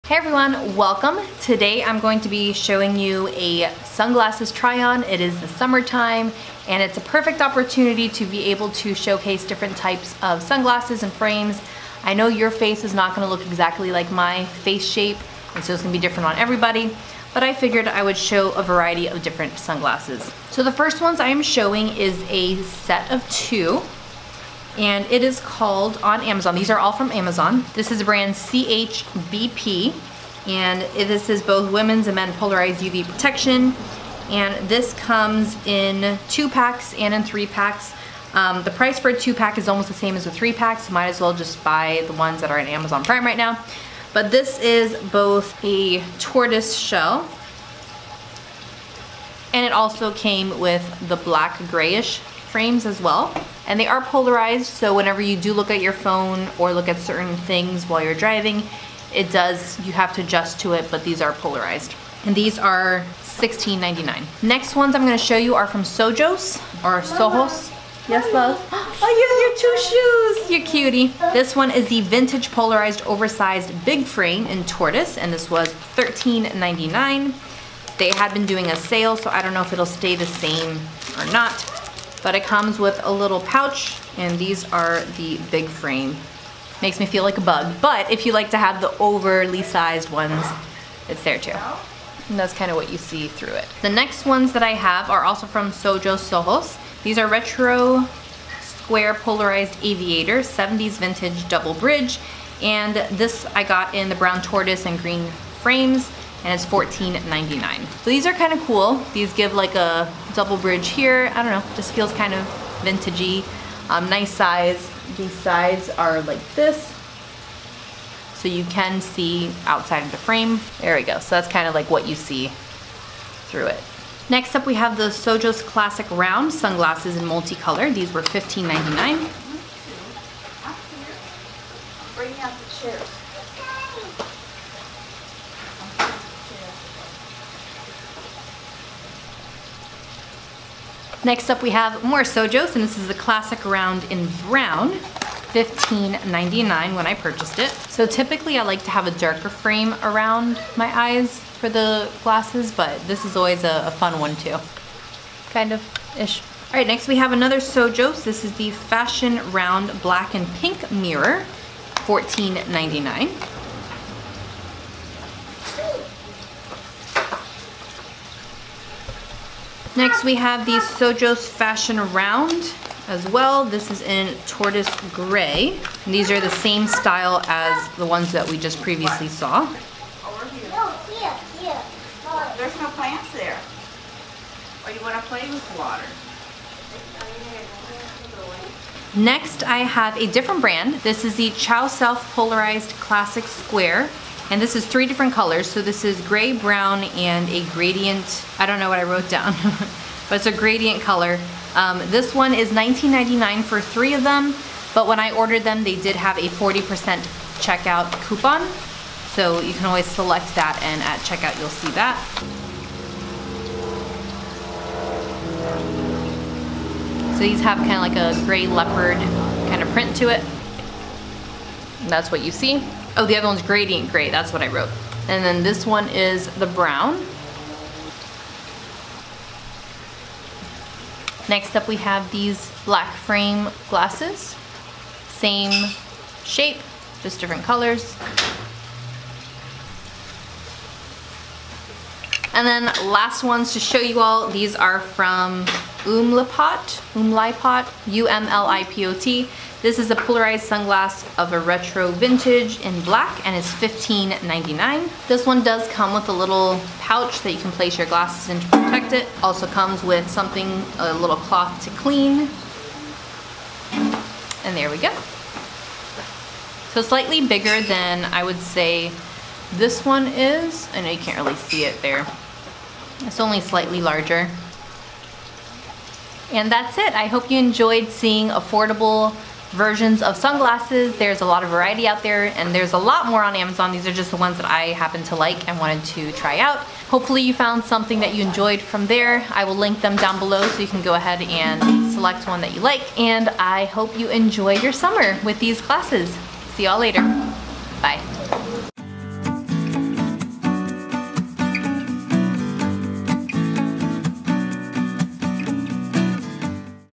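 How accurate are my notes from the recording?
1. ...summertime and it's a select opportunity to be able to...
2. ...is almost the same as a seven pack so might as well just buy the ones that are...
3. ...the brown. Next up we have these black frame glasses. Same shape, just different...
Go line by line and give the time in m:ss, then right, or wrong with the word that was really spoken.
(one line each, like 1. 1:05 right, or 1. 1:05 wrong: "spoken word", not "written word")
1. 0:05 wrong: "perfect", not "select"
2. 0:39 wrong: "three", not "seven"
3. 3:46 right.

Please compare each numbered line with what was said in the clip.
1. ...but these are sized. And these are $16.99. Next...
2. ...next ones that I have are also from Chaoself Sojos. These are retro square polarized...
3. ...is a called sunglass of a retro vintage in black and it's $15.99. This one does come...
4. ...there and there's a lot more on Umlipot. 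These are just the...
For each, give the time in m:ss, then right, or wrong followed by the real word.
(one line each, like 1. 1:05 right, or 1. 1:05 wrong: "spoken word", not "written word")
1. 1:00 wrong: "polarized", not "sized"
2. 1:33 wrong: "Sojo", not "Chaoself"
3. 4:09 wrong: "polarized", not "called"
4. 4:42 wrong: "Amazon", not "Umlipot".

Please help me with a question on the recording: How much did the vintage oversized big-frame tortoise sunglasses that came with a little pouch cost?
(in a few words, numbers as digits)
$13.99.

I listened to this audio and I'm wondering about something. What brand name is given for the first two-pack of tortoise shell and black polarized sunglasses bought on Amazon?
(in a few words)
CHBP.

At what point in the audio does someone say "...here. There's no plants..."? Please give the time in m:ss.
3:01.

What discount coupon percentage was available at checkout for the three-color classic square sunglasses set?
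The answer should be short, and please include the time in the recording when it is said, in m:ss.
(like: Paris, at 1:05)
40%, at 3:26.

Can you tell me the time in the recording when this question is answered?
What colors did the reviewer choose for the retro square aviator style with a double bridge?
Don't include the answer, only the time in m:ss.
1:44.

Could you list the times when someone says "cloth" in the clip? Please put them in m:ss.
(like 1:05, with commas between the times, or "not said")
4:21.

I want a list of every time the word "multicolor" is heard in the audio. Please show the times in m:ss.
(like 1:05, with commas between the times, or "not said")
2:07.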